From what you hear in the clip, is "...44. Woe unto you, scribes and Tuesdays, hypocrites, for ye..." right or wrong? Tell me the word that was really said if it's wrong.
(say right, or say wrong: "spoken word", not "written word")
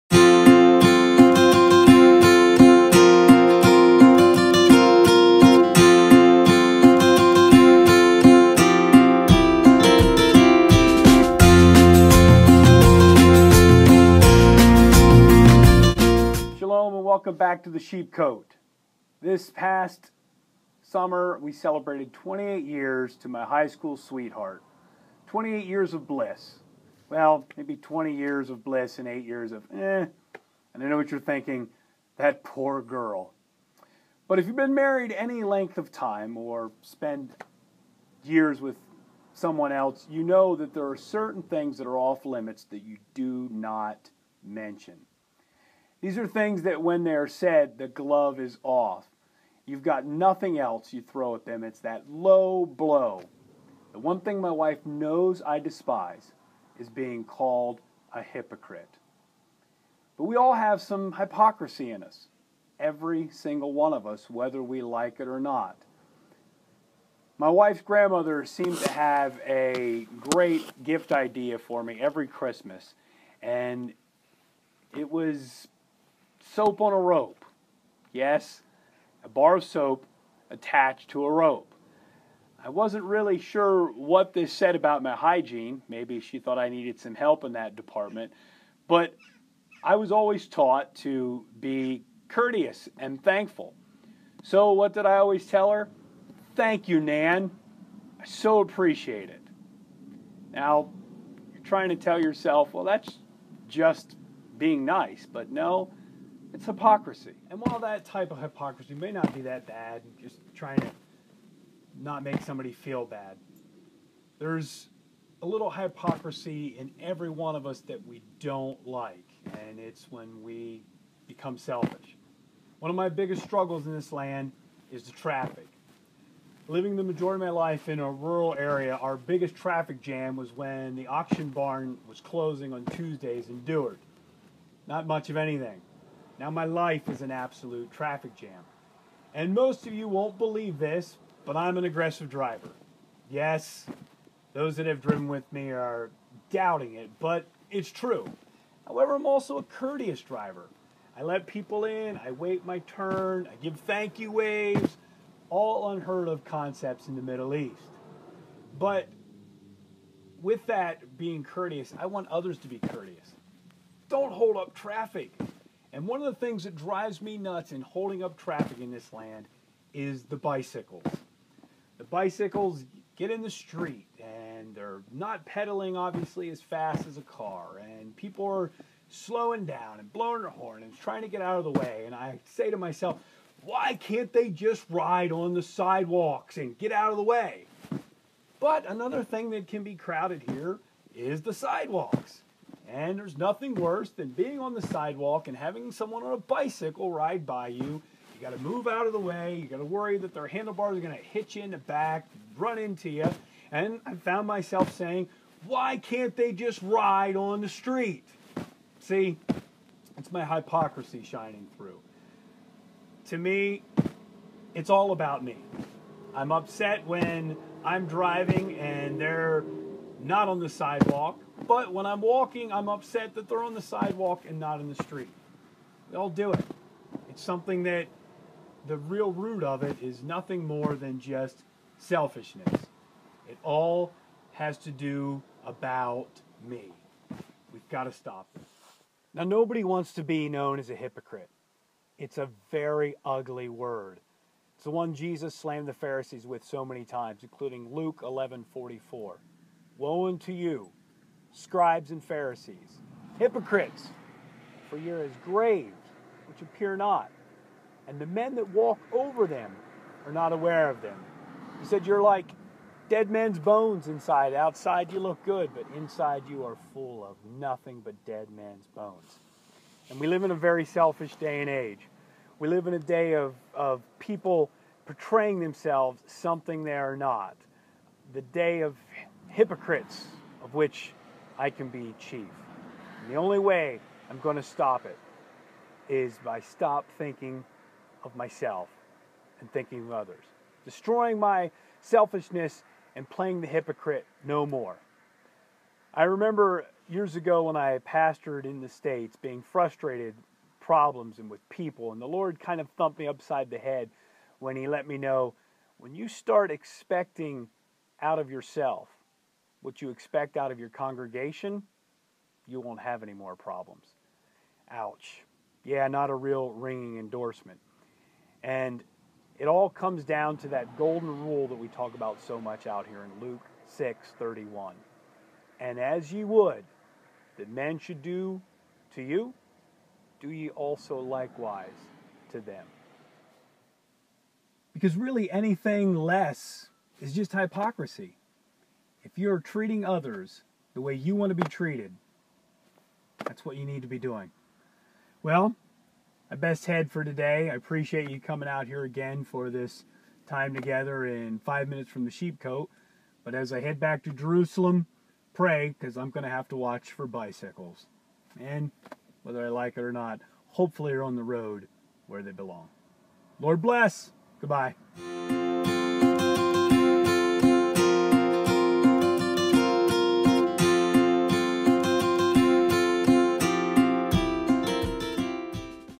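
wrong: "Pharisees", not "Tuesdays".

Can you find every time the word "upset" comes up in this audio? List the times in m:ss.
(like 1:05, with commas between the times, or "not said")
3:36, 3:42.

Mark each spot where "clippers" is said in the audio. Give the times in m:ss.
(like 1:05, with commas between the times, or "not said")
not said.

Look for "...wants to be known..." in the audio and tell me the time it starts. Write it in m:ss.
3:59.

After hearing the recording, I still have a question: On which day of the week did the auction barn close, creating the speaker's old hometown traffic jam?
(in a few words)
Tuesdays.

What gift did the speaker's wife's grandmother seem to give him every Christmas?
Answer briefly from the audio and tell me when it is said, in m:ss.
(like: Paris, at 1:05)
soap on a rope, at 1:16.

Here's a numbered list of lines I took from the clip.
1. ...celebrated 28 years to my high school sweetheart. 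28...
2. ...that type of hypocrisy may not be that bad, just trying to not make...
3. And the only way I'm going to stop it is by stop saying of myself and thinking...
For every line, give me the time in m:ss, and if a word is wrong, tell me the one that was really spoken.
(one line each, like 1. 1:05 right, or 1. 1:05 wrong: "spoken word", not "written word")
1. 0:21 right
2. 1:47 right
3. 4:43 wrong: "thinking", not "saying".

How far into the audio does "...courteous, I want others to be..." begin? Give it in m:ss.
2:41.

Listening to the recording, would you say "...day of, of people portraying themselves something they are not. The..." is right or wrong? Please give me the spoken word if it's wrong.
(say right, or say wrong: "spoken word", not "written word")
right.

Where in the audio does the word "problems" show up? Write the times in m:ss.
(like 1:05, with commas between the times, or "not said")
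5:00, 5:13.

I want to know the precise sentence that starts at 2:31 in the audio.
I let people in, I wait my turn, I give thank you waves, all unheard of concepts in the Middle East.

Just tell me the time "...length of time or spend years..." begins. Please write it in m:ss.
0:35.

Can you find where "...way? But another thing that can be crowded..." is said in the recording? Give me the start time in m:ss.
3:07.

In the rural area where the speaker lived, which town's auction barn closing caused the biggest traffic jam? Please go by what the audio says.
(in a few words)
Deward.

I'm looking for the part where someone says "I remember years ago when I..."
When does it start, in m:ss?
4:56.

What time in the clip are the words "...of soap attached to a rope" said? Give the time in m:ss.
1:19.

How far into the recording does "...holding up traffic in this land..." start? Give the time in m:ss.
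2:47.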